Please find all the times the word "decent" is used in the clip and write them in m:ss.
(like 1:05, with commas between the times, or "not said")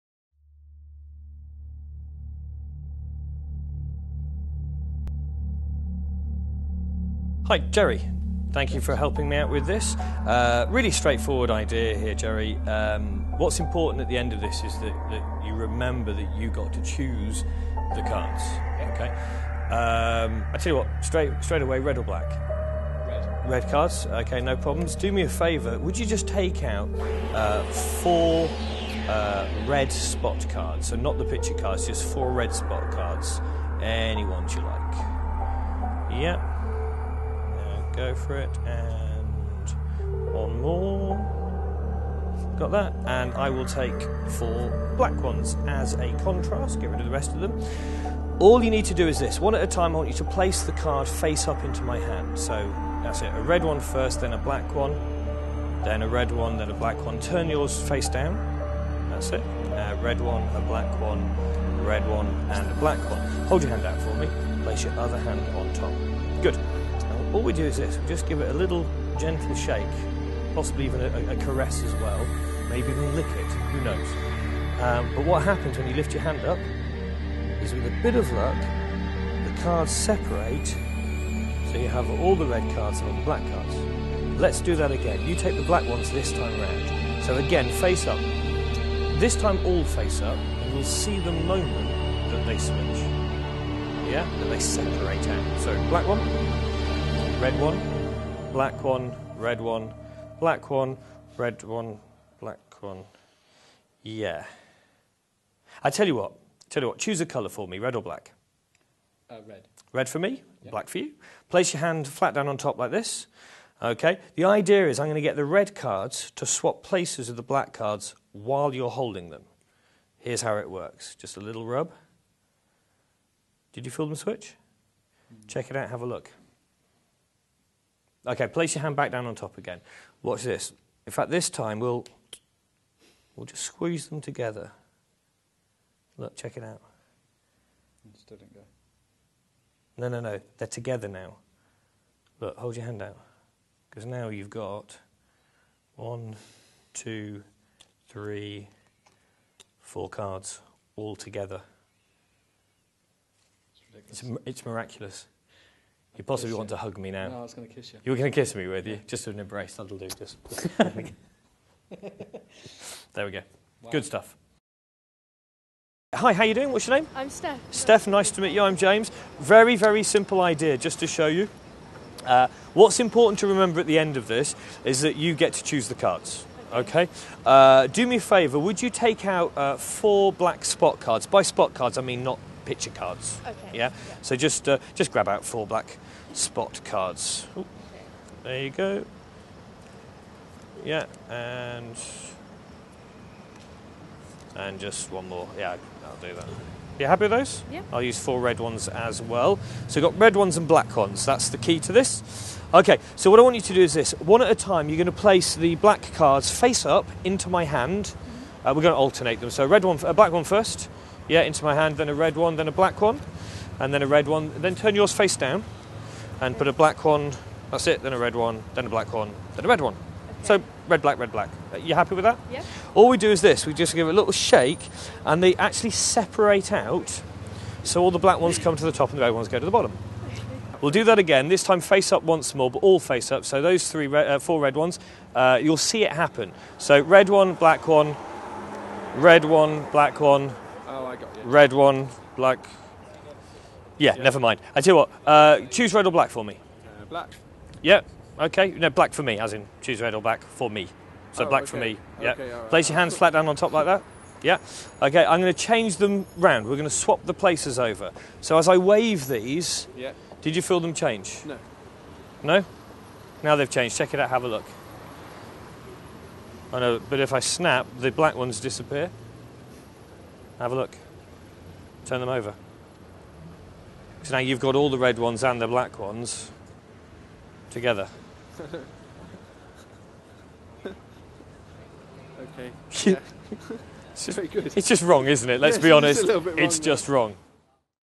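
not said.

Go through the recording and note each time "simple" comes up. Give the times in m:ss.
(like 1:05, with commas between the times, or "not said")
2:50.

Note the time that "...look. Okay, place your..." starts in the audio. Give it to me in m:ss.
2:06.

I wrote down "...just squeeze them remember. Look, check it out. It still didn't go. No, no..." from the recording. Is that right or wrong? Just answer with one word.
wrong.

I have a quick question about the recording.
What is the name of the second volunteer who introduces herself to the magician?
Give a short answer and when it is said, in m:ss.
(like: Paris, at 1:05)
Steph, at 2:47.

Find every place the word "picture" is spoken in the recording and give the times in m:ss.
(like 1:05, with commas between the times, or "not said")
0:31, 3:02.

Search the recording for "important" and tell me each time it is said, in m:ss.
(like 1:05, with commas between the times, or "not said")
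0:13, 2:52.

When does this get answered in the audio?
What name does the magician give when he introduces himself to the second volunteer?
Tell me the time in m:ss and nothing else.
2:48.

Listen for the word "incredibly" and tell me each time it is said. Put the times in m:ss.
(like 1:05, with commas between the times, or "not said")
not said.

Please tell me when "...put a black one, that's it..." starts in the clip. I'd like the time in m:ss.
3:36.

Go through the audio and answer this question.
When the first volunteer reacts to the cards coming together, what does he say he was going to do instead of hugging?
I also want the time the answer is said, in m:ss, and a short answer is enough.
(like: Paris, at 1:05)
Kiss you, at 2:37.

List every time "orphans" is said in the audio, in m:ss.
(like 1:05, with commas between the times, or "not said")
not said.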